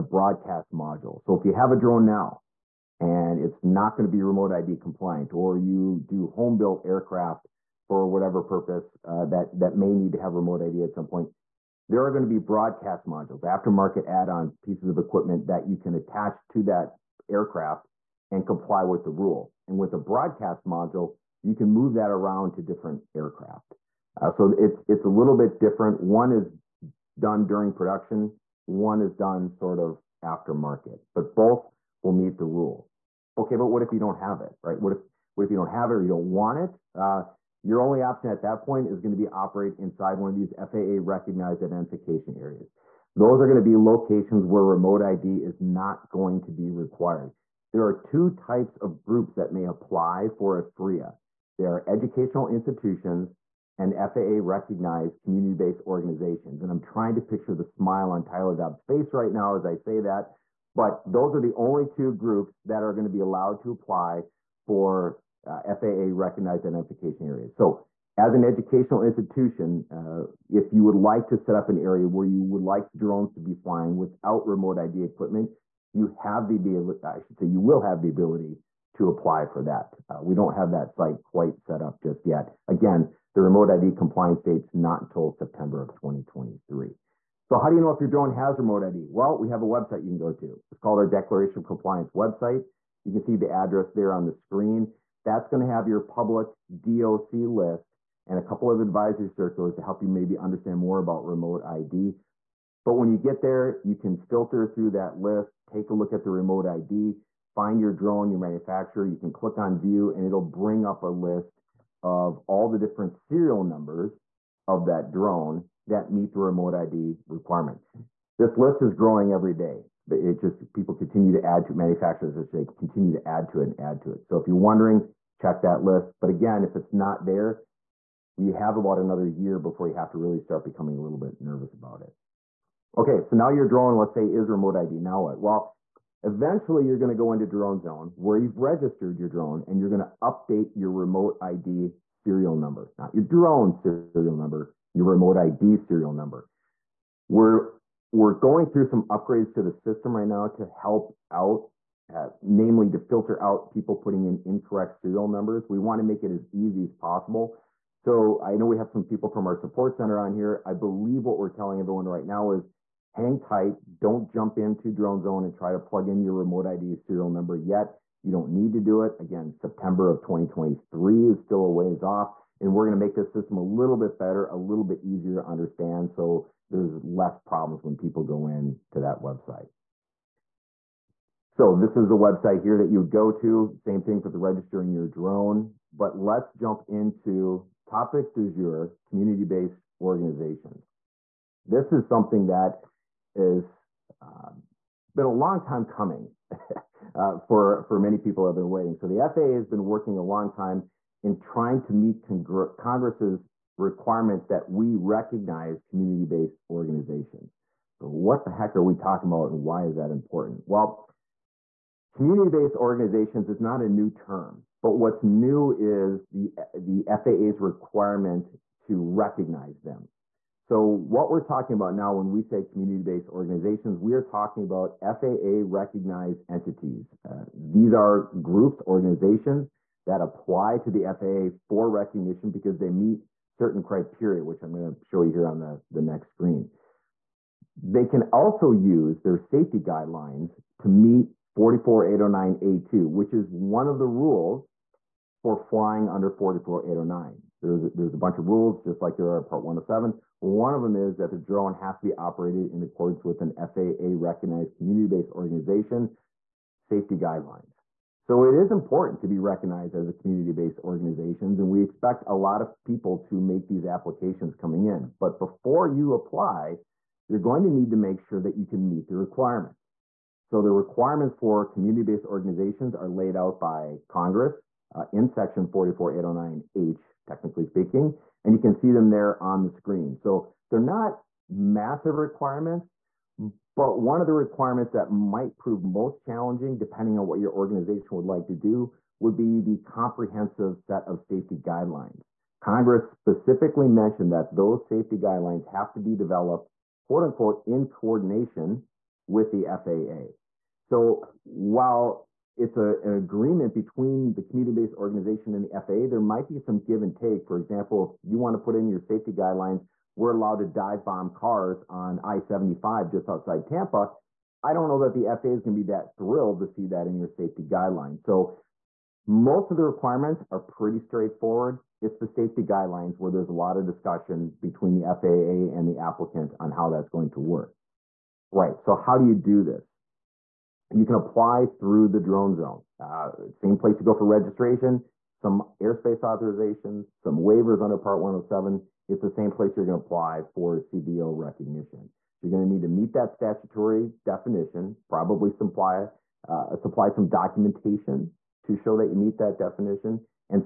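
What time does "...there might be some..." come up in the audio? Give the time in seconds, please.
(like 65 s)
306 s.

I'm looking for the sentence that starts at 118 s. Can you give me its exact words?
This list is growing every day.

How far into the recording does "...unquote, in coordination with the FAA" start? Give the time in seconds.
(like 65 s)
297 s.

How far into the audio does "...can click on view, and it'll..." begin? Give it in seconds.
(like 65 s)
109 s.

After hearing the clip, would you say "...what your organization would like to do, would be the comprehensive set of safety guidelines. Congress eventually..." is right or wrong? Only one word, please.
wrong.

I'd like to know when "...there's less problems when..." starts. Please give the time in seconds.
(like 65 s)
176 s.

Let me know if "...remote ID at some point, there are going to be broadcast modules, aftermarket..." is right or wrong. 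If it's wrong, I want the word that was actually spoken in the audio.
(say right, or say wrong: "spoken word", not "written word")
right.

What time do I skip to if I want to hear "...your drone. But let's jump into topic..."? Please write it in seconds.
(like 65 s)
184 s.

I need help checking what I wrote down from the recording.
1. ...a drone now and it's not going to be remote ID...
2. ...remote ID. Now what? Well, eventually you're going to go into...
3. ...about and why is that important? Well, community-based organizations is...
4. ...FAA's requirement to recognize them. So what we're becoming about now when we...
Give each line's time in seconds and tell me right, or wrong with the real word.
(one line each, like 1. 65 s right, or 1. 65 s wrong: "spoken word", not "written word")
1. 1 s right
2. 134 s right
3. 209 s right
4. 217 s wrong: "talking", not "becoming".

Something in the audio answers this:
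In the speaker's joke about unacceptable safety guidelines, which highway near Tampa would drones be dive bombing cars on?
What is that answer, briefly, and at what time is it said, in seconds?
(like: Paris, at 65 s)
I-75, at 312 s.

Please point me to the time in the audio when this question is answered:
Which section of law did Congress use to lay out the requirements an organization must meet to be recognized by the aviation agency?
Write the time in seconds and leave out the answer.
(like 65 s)
275 s.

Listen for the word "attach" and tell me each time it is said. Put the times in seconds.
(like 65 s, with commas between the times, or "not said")
15 s.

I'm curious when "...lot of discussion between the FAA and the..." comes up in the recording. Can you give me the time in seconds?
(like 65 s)
323 s.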